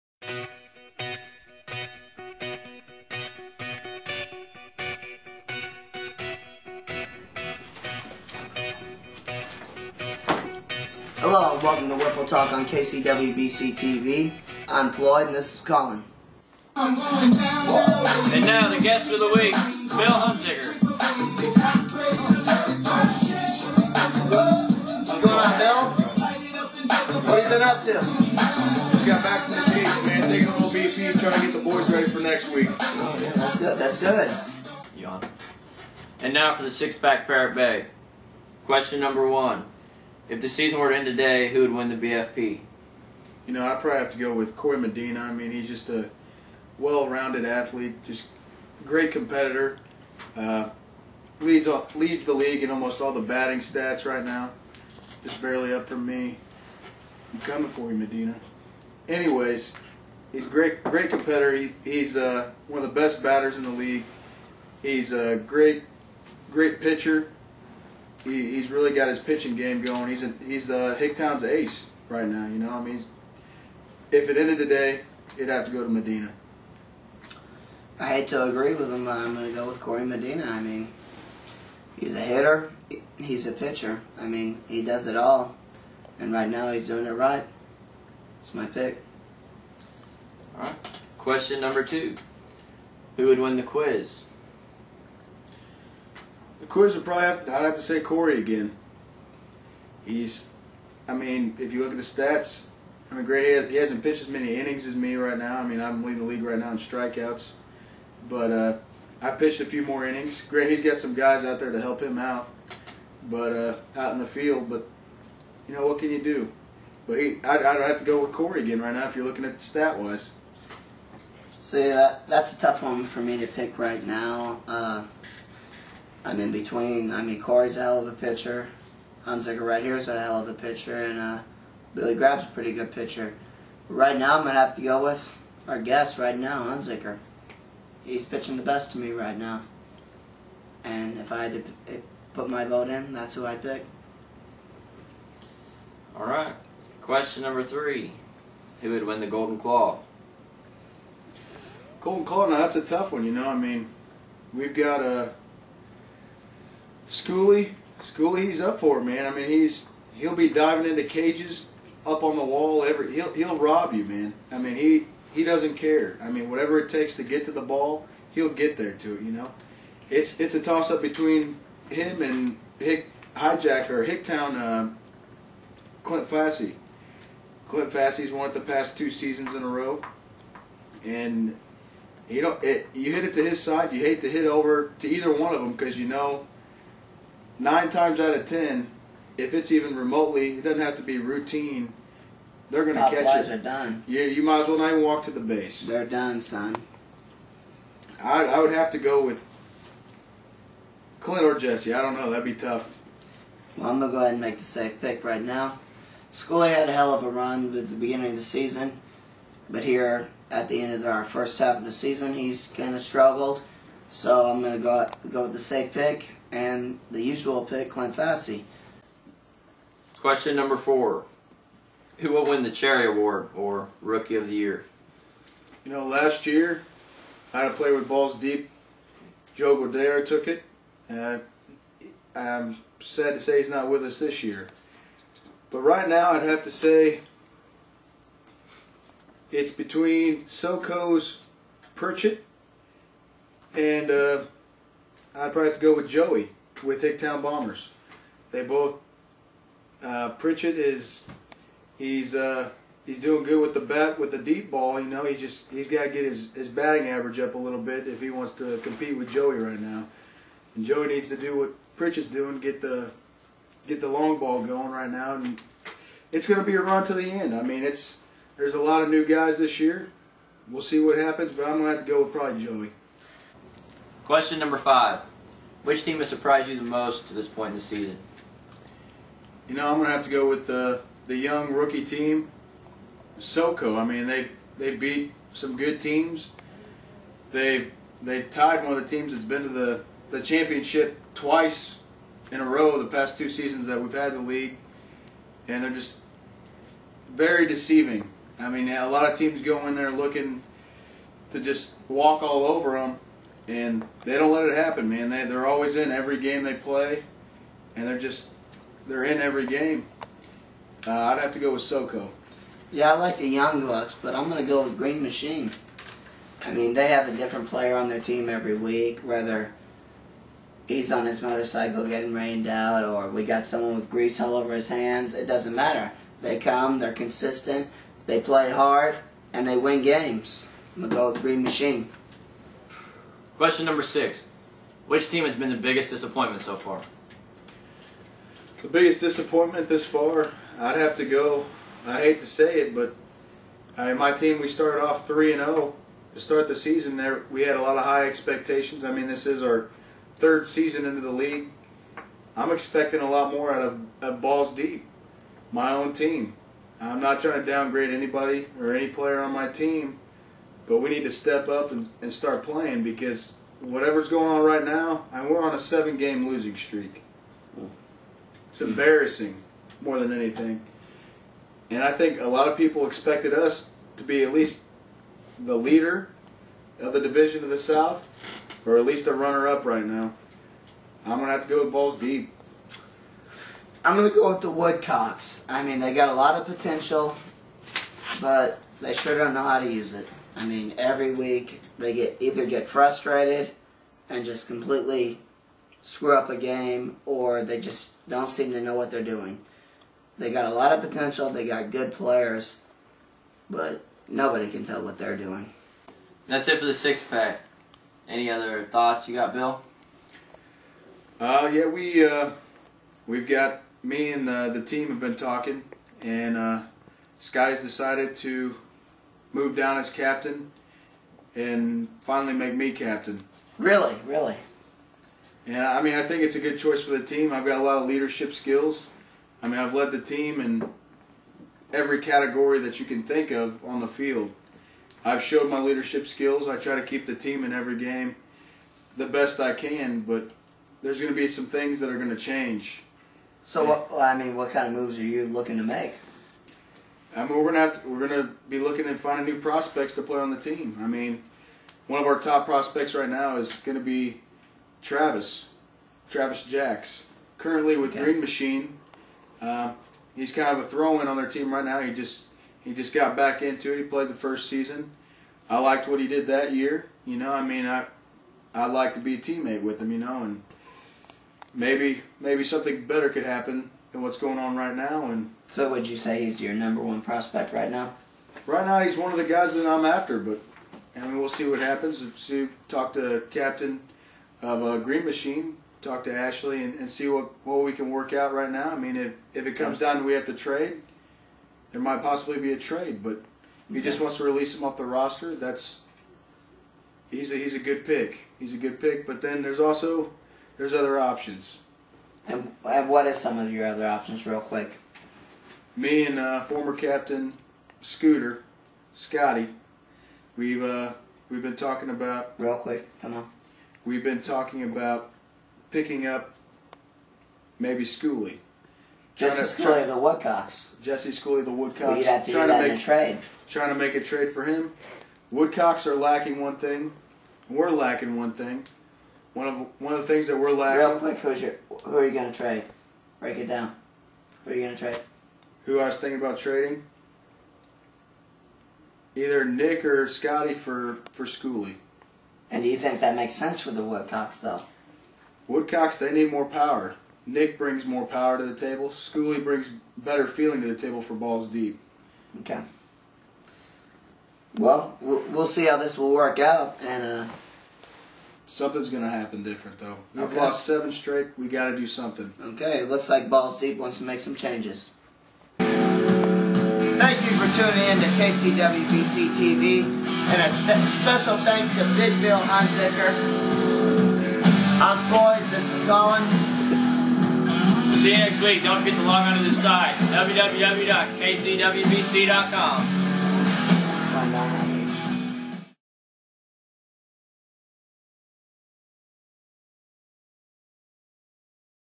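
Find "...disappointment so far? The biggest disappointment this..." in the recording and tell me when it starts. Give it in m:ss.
5:36.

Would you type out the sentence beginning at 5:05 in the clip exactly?
They they're always in every game they play, and they're just they're in every game.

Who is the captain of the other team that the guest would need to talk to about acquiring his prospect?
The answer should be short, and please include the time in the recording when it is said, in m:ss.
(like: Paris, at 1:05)
Ashley, at 8:06.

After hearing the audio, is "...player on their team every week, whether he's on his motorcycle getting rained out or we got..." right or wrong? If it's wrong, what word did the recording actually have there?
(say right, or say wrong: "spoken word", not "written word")
right.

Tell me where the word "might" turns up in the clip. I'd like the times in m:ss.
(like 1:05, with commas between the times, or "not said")
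3:14, 8:12.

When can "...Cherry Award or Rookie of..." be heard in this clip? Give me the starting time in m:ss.
3:42.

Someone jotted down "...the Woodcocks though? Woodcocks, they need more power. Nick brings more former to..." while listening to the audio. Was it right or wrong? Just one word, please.
wrong.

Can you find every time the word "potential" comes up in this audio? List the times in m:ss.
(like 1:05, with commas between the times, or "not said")
6:26, 6:41.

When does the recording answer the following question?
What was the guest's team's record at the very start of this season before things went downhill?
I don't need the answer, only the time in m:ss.
5:45.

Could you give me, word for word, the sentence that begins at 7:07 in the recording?
I've got a lot of leadership skills.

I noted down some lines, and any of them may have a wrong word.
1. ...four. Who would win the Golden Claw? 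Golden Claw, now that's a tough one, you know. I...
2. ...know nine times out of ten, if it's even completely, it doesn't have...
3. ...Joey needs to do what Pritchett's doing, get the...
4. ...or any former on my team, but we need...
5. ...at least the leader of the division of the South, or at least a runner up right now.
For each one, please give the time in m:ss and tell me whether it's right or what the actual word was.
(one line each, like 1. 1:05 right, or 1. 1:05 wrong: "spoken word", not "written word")
1. 2:27 wrong: "three", not "four"
2. 3:06 wrong: "remotely", not "completely"
3. 4:20 right
4. 5:58 wrong: "player", not "former"
5. 6:14 right.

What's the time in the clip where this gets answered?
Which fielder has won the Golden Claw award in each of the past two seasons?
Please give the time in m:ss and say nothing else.
2:57.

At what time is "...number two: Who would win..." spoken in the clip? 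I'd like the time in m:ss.
1:31.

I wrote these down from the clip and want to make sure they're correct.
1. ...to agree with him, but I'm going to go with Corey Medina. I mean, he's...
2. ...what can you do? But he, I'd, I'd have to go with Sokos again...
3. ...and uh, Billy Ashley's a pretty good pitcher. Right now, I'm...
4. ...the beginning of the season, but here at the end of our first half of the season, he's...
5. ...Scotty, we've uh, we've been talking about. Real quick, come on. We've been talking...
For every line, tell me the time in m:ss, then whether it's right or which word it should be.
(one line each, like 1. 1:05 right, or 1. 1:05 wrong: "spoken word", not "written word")
1. 1:18 right
2. 1:55 wrong: "Corey", not "Sokos"
3. 2:10 wrong: "Grab", not "Ashley"
4. 3:27 right
5. 8:29 right.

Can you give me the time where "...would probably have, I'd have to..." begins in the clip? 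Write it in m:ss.
1:36.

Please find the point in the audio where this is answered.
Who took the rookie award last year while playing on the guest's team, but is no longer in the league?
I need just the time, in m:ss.
3:49.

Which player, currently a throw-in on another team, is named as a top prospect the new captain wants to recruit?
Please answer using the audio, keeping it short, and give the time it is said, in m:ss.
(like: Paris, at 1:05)
Travis Jacks, at 7:36.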